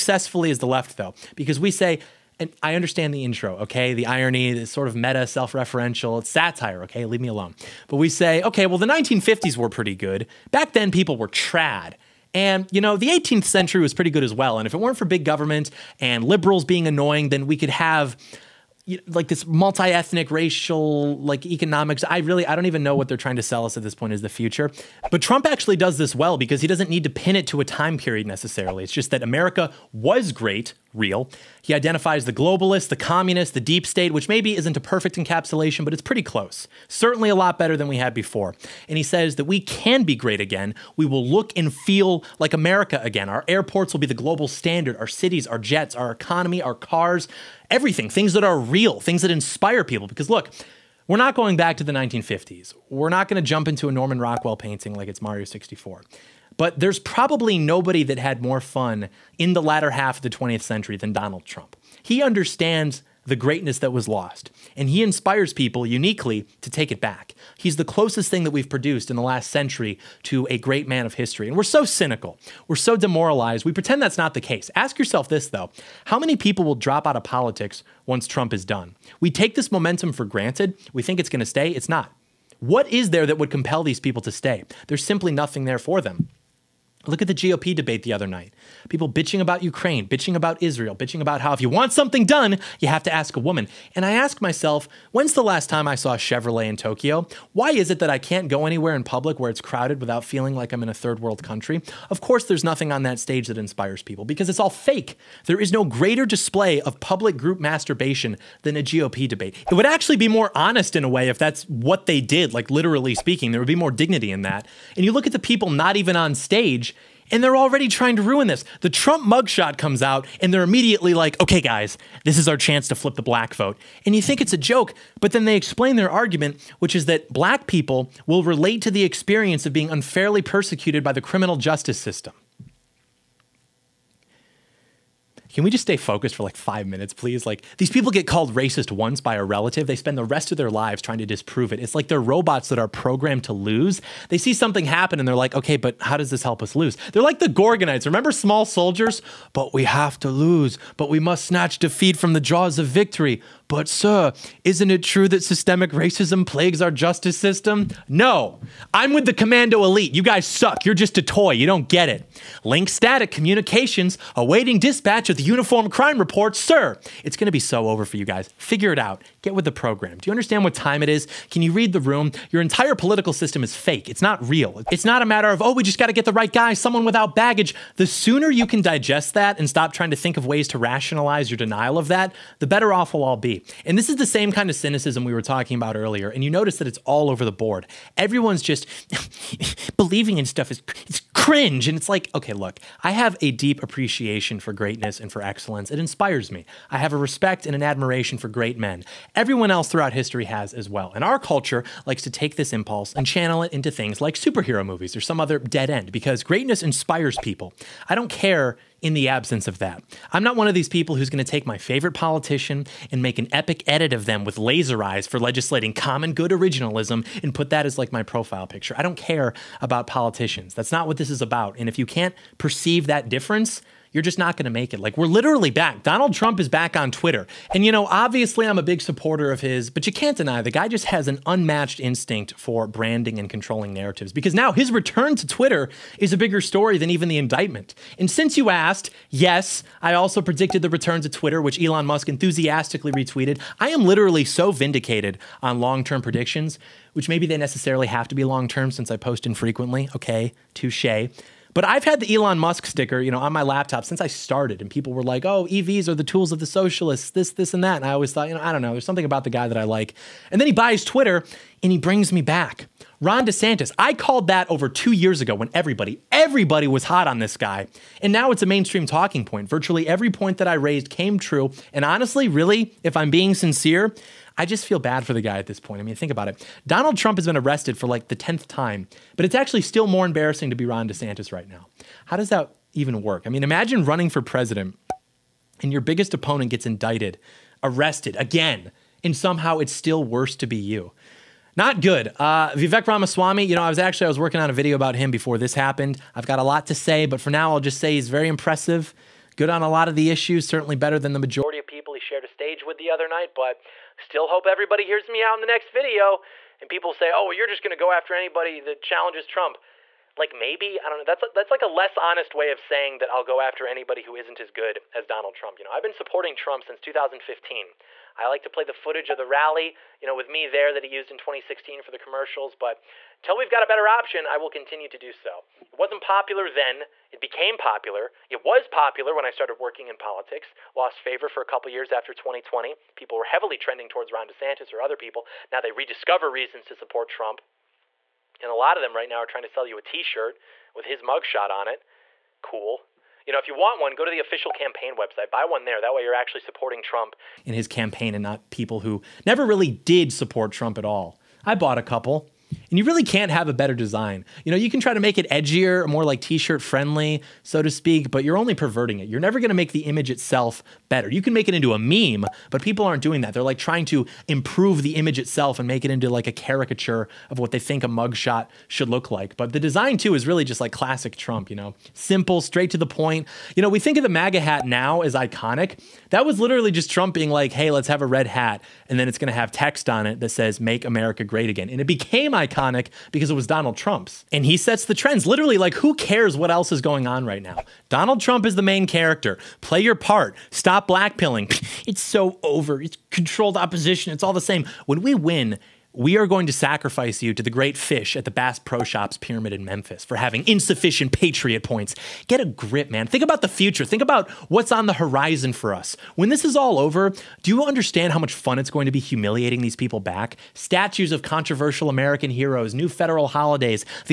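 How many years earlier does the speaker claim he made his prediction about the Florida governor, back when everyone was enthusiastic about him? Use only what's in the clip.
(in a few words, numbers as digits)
2.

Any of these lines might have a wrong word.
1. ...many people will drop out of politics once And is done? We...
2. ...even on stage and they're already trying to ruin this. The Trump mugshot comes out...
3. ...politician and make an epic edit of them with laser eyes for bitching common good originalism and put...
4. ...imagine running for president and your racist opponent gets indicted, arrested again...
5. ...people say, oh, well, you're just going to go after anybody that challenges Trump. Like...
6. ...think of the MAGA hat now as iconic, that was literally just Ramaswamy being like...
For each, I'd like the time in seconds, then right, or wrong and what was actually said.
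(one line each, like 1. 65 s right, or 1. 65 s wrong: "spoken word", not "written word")
1. 76 s wrong: "Trump", not "And"
2. 115 s right
3. 212 s wrong: "legislating", not "bitching"
4. 283 s wrong: "biggest", not "racist"
5. 306 s right
6. 373 s wrong: "Trump", not "Ramaswamy".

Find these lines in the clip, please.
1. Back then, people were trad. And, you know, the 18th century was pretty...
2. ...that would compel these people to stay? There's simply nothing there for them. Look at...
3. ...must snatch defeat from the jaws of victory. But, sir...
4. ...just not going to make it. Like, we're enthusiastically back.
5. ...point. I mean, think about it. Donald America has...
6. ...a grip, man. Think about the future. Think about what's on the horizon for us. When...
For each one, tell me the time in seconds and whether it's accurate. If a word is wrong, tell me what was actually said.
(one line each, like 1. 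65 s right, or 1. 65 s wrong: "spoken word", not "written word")
1. 10 s right
2. 83 s right
3. 151 s right
4. 224 s wrong: "literally", not "enthusiastically"
5. 275 s wrong: "Trump", not "America"
6. 402 s right.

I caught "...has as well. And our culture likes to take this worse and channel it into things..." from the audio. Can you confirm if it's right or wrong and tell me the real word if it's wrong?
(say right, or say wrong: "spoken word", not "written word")
wrong: "impulse", not "worse".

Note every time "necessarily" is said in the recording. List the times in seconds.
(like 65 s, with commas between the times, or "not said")
28 s, 247 s.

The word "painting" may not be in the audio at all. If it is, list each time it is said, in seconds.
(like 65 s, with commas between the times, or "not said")
54 s.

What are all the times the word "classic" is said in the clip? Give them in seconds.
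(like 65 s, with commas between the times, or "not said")
370 s.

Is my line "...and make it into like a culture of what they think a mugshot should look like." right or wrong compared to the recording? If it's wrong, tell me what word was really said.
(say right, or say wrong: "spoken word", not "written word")
wrong: "caricature", not "culture".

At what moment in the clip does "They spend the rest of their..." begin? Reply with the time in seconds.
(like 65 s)
139 s.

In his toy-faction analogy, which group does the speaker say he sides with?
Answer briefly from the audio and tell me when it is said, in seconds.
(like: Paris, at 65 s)
Commando Elite, at 159 s.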